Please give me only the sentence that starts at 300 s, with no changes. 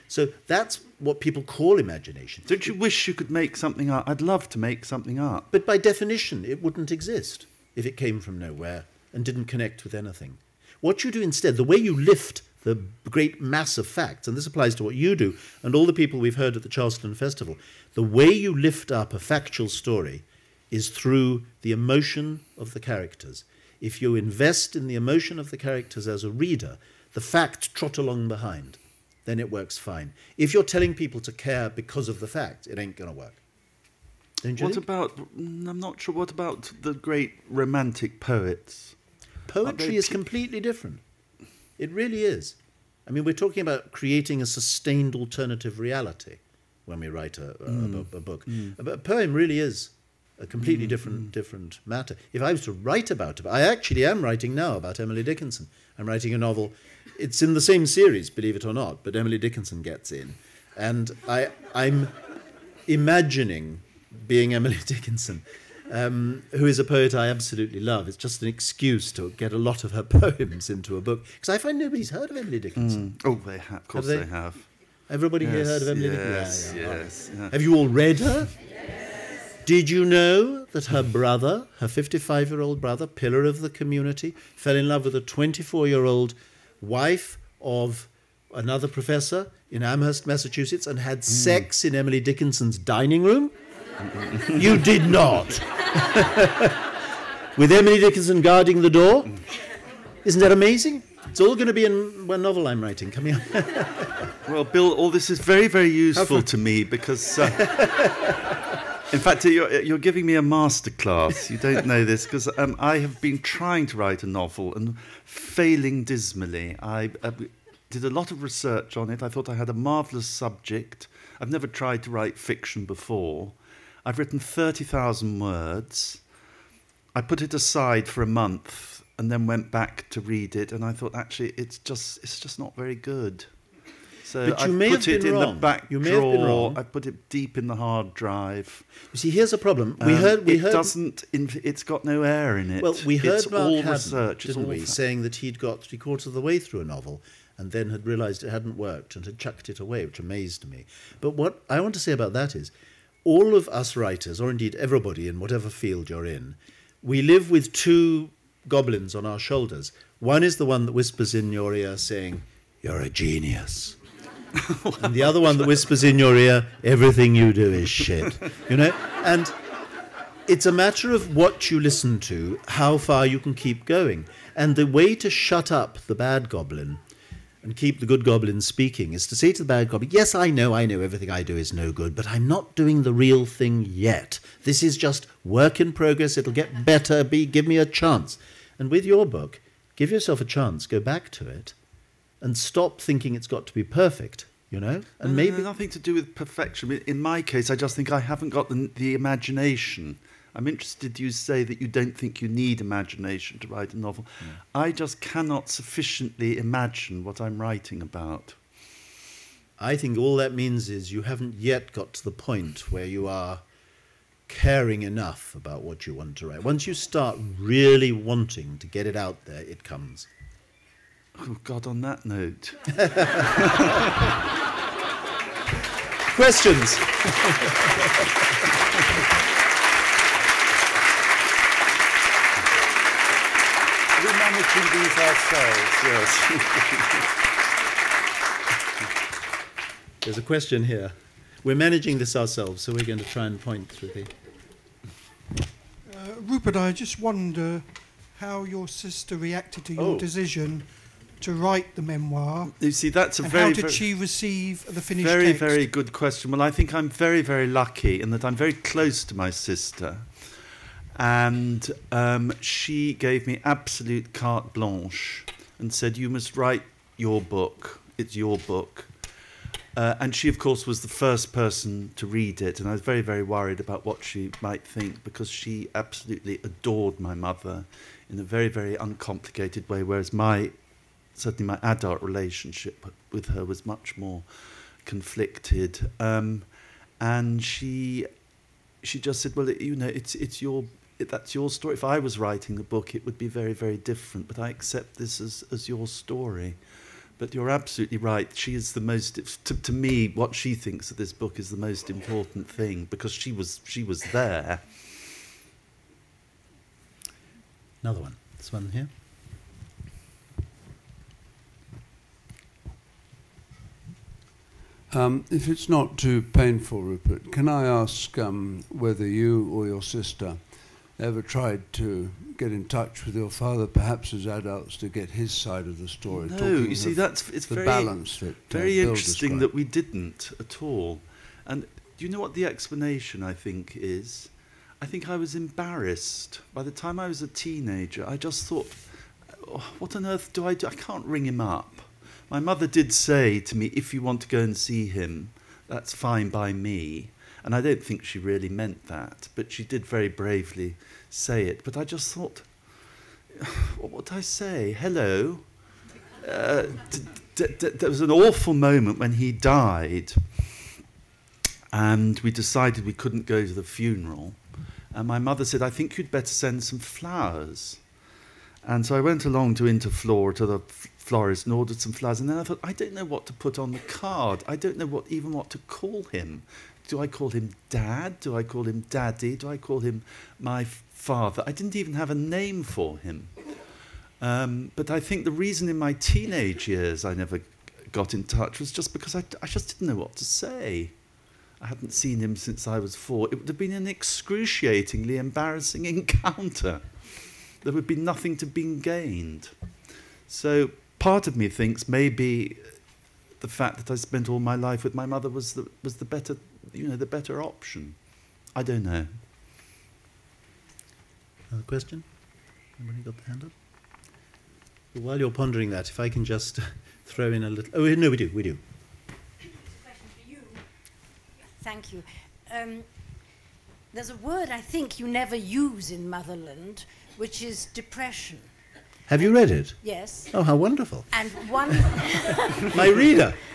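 What she thinks of this book is the most important thing because she was she was there.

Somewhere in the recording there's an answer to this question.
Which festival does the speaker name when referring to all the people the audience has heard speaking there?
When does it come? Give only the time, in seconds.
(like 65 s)
16 s.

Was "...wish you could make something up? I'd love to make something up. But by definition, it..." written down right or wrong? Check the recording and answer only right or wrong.
right.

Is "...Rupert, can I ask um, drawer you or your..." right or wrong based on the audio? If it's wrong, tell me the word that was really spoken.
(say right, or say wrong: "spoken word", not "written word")
wrong: "whether", not "drawer".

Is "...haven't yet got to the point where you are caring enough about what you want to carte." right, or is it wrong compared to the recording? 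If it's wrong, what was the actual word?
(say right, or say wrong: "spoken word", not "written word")
wrong: "write", not "carte".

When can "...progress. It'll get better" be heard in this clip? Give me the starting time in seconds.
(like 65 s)
185 s.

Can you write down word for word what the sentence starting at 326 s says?
No, you see, that's it's very, that, uh, very uh, interesting that we didn't at all.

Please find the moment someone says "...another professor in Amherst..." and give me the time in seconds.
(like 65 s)
88 s.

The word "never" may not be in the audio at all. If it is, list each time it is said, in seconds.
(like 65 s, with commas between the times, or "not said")
121 s, 387 s, 425 s.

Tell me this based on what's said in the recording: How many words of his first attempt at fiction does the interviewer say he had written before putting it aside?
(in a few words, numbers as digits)
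30,000.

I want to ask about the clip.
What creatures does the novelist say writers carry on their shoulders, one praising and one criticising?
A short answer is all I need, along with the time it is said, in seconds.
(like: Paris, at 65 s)
goblins, at 157 s.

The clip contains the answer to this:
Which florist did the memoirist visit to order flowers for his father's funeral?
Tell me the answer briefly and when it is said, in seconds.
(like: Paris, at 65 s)
Interflora, at 369 s.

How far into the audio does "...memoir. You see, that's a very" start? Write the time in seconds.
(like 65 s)
252 s.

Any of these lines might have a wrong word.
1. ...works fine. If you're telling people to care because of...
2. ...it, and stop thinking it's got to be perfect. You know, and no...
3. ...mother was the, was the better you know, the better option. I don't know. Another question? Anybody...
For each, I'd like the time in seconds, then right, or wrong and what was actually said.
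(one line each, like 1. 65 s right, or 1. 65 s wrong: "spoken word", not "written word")
1. 29 s right
2. 191 s right
3. 405 s right.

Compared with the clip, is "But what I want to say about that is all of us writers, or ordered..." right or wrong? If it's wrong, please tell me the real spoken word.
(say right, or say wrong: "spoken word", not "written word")
wrong: "indeed", not "ordered".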